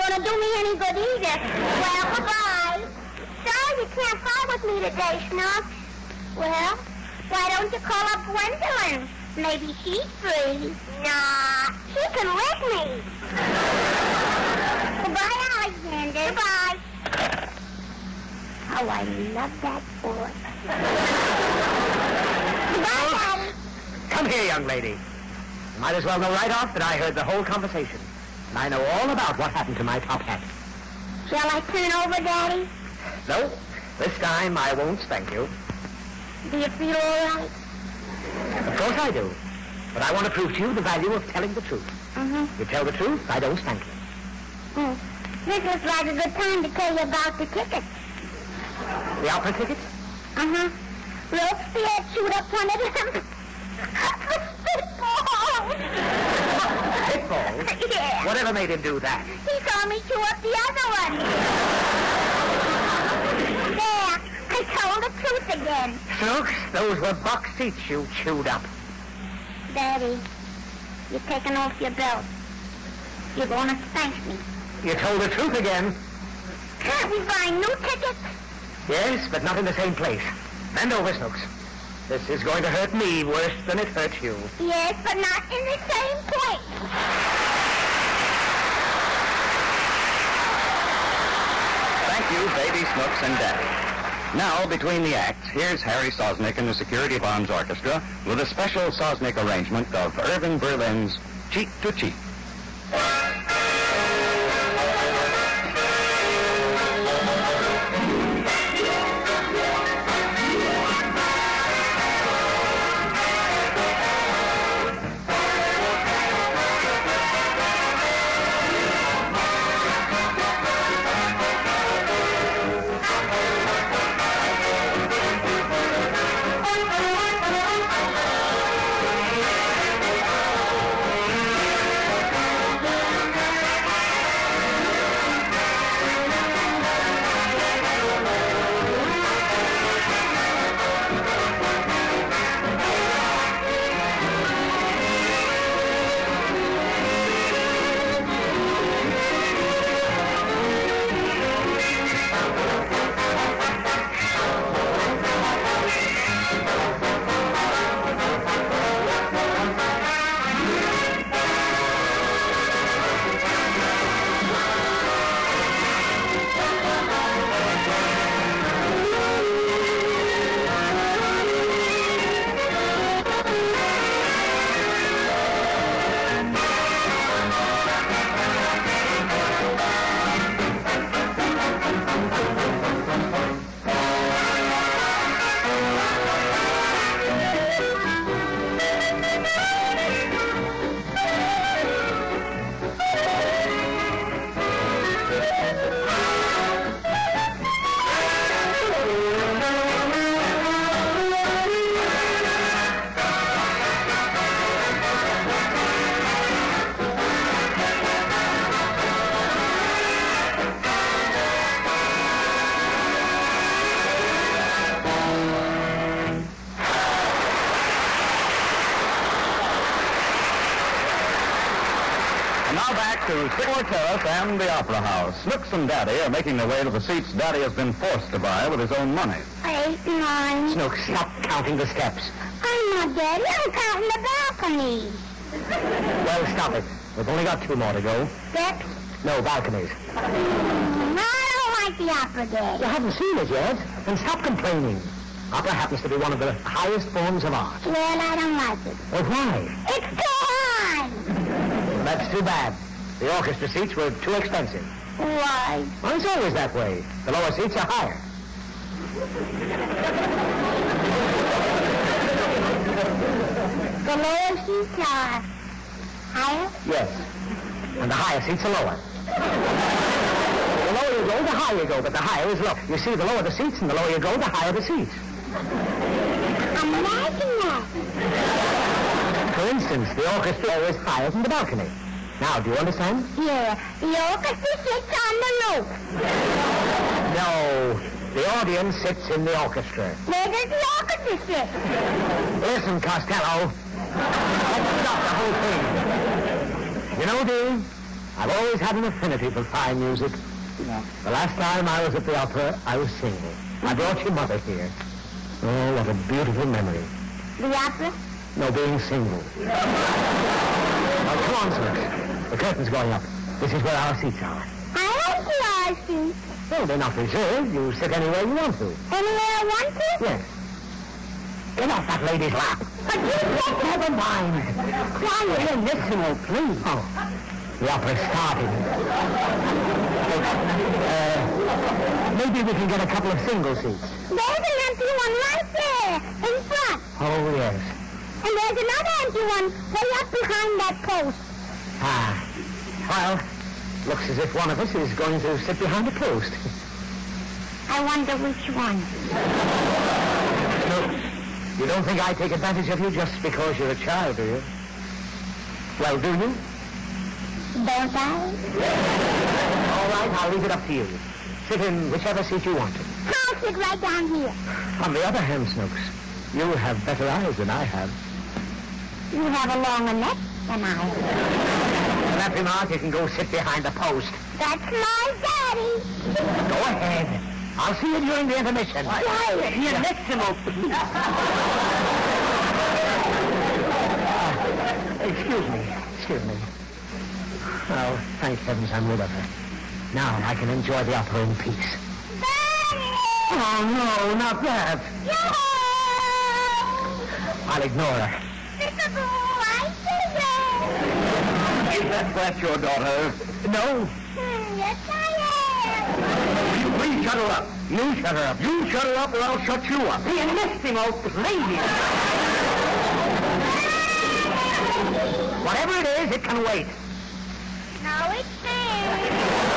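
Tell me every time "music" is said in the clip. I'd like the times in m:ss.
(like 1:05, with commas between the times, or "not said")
4:59.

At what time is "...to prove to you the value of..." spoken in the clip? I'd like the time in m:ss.
0:40.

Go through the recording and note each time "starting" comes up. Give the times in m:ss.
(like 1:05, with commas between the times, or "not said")
5:28.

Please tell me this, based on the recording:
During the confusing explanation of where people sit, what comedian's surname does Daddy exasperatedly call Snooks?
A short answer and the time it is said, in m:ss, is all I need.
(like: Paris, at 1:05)
Costello, at 4:52.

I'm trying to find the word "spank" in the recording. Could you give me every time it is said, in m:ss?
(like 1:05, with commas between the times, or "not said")
0:34, 0:43, 1:13.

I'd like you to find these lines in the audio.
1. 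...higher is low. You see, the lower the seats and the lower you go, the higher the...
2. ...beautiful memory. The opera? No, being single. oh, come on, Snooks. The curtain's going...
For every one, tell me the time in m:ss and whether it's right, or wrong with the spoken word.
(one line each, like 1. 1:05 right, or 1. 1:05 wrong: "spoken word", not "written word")
1. 4:32 right
2. 5:06 right.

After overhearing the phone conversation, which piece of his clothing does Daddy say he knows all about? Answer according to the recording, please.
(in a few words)
top hat.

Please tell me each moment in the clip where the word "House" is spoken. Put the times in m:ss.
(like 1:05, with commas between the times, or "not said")
3:44.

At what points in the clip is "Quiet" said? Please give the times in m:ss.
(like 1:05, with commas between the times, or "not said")
5:25, 6:19.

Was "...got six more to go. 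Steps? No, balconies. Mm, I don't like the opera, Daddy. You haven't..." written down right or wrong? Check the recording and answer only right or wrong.
wrong.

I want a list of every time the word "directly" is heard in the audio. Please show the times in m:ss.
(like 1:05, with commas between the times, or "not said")
not said.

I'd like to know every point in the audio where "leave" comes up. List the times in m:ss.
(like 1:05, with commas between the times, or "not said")
6:00.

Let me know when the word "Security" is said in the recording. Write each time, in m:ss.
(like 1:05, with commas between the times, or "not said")
1:36.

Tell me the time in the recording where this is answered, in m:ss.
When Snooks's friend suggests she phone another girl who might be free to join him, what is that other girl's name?
0:08.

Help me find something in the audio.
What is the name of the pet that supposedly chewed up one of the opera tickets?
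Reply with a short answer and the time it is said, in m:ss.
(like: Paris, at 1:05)
Robespierre, at 0:51.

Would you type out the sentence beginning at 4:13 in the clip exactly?
The orchestra seats were too expensive.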